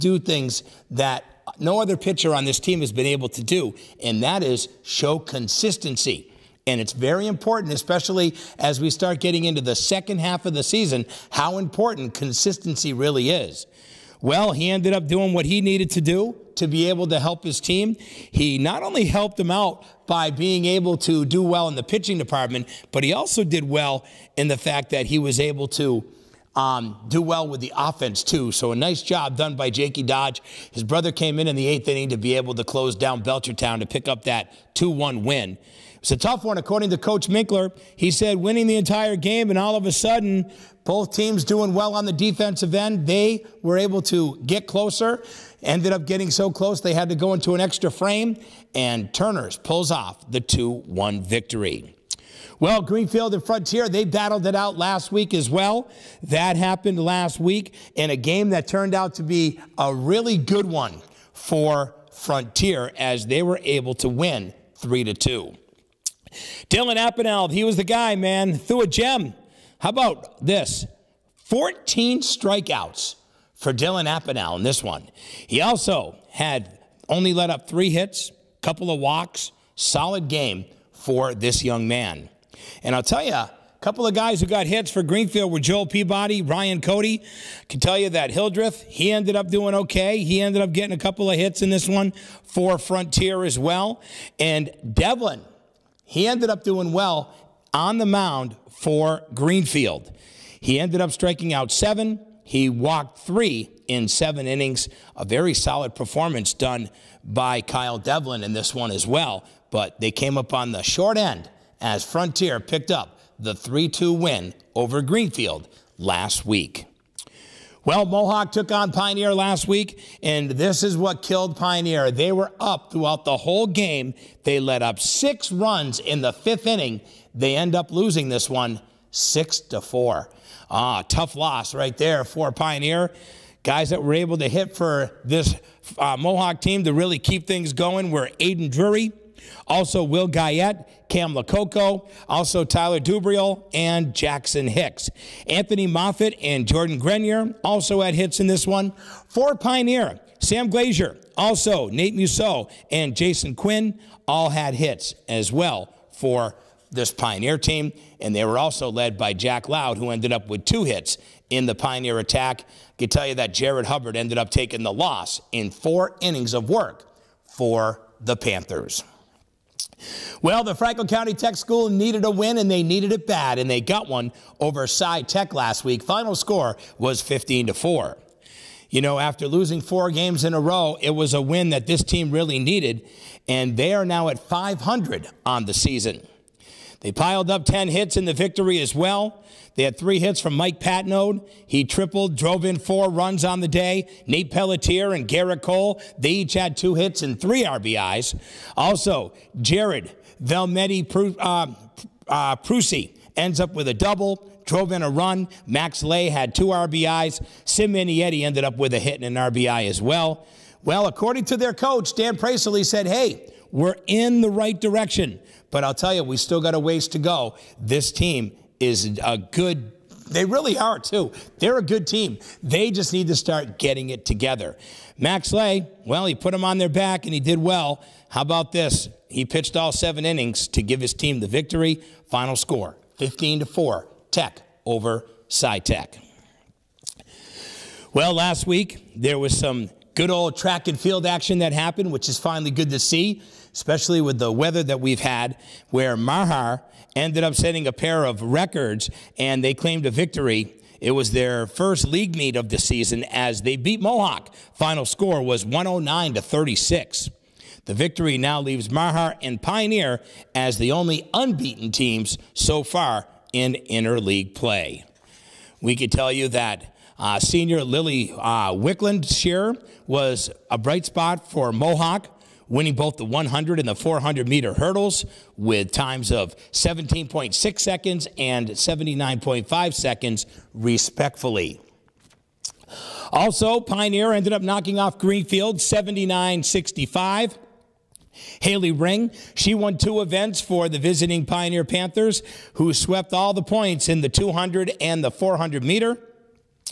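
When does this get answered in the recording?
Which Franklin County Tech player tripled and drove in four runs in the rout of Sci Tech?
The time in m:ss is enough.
3:10.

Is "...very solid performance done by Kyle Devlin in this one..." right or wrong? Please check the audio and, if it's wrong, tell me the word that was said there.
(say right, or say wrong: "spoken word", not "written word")
right.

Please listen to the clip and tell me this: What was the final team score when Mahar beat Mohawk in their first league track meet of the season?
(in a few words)
109 to 36.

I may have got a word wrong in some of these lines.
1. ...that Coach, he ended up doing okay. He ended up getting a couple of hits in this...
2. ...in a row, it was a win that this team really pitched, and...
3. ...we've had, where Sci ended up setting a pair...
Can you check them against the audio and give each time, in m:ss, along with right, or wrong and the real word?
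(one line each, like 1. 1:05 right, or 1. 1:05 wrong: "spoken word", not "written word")
1. 1:28 wrong: "Hildreth", not "Coach"
2. 3:00 wrong: "needed", not "pitched"
3. 4:04 wrong: "Mahar", not "Sci".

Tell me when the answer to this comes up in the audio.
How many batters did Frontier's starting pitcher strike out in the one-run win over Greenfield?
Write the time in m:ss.
1:11.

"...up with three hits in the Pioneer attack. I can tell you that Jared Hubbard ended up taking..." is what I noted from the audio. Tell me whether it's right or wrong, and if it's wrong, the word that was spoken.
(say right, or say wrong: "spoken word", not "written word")
wrong: "two", not "three".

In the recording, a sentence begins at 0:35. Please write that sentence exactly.
It's a tough one, according to Coach Minkler.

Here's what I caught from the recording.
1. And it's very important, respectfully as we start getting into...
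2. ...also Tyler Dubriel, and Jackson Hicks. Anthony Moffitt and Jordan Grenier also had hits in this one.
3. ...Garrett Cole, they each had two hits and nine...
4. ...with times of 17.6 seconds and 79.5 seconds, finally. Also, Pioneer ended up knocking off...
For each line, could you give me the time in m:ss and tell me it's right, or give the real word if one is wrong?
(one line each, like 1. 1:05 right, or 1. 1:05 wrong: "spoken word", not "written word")
1. 0:06 wrong: "especially", not "respectfully"
2. 2:22 right
3. 3:15 wrong: "three", not "nine"
4. 4:35 wrong: "respectfully", not "finally".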